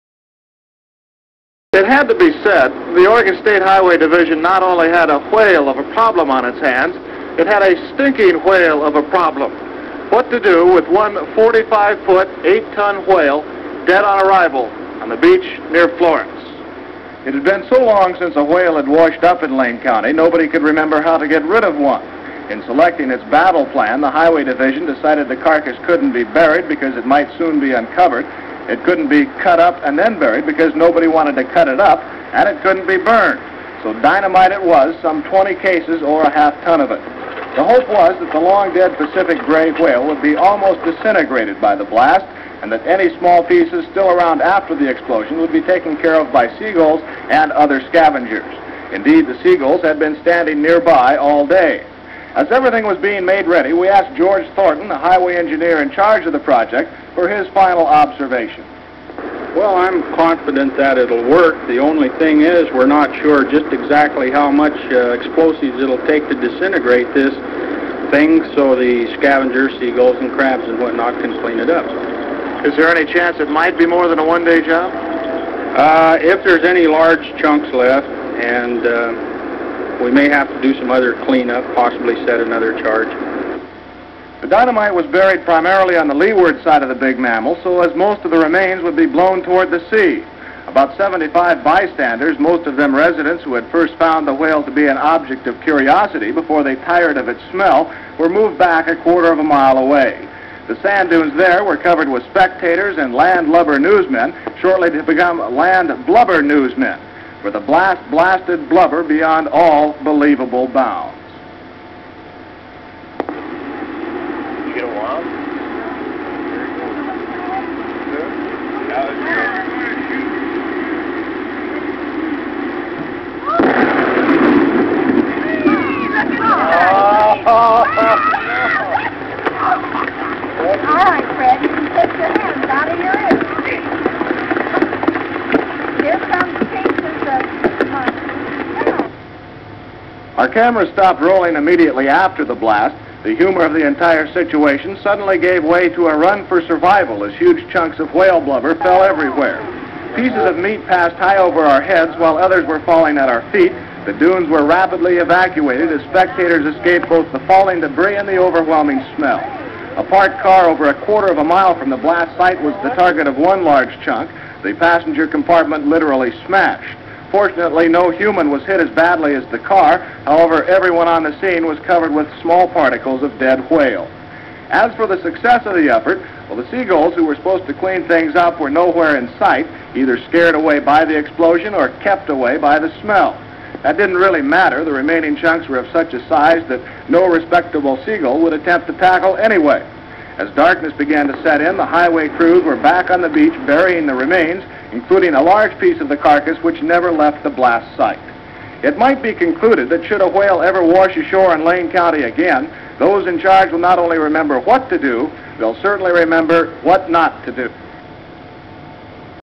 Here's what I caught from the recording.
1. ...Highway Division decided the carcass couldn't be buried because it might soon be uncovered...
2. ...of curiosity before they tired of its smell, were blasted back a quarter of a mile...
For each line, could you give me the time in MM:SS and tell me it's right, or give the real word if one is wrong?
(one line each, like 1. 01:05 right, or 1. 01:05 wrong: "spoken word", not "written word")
1. 00:24 right
2. 01:35 wrong: "moved", not "blasted".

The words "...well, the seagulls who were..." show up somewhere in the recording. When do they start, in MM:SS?
02:56.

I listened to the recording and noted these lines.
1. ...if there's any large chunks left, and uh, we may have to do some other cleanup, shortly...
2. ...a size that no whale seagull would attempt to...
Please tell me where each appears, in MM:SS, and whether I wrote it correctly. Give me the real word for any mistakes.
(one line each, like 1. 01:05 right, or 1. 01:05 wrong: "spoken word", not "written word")
1. 01:16 wrong: "possibly", not "shortly"
2. 03:06 wrong: "respectable", not "whale".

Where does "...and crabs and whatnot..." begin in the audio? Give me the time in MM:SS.
01:10.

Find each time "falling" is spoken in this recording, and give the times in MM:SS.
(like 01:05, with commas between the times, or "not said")
02:32, 02:37.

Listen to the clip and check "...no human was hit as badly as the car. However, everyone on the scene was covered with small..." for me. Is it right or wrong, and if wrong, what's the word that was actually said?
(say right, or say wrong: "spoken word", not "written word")
right.